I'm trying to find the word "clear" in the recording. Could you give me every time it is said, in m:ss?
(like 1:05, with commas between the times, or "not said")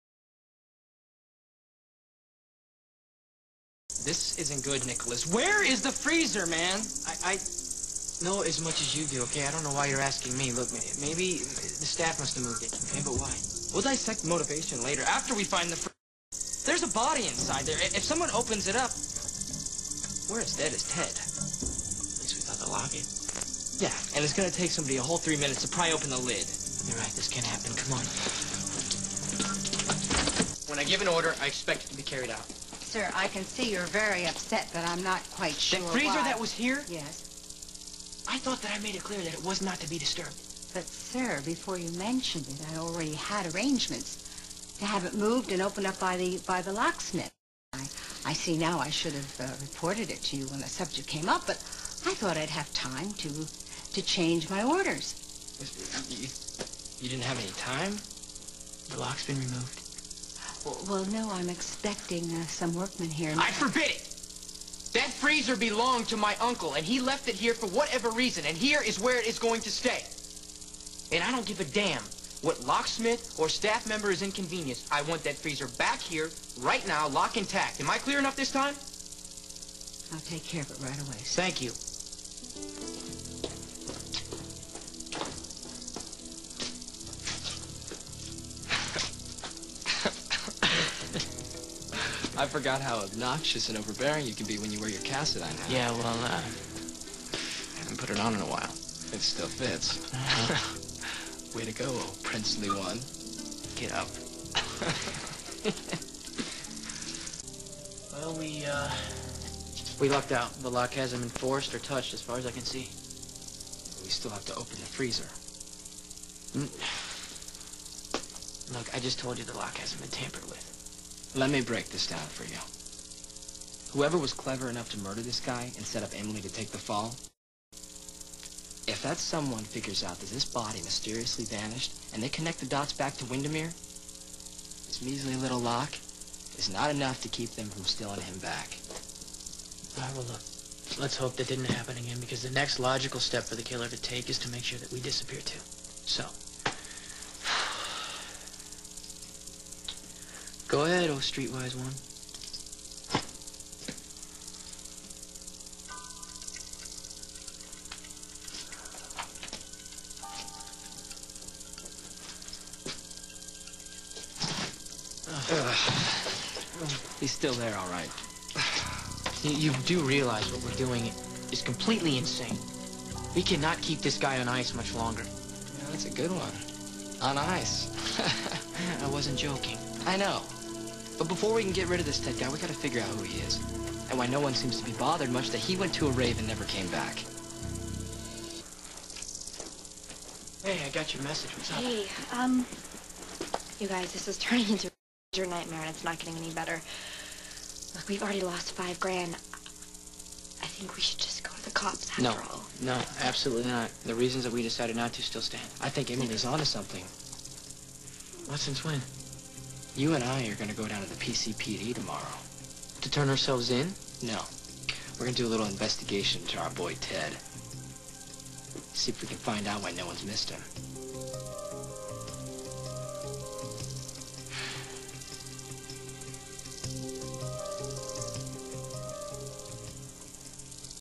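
0:39, 1:17.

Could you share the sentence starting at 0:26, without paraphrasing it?
You're right, this can not happen.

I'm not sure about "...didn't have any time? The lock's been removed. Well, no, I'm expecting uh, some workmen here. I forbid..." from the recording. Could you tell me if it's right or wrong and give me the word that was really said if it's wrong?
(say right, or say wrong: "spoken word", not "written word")
right.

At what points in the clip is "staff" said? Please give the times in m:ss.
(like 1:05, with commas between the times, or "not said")
0:11, 1:13.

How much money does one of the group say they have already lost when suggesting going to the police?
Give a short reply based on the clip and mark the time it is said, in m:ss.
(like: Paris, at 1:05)
$5,000, at 3:18.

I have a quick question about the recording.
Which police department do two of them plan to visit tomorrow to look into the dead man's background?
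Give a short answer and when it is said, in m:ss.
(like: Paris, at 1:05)
PCPD, at 3:31.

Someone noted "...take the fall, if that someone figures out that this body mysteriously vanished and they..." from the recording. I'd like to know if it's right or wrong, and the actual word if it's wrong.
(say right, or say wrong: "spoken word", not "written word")
right.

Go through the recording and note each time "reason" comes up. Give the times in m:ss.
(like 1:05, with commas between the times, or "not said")
1:08, 3:24.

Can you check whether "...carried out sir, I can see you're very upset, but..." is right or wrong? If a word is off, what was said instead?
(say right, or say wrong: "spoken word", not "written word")
right.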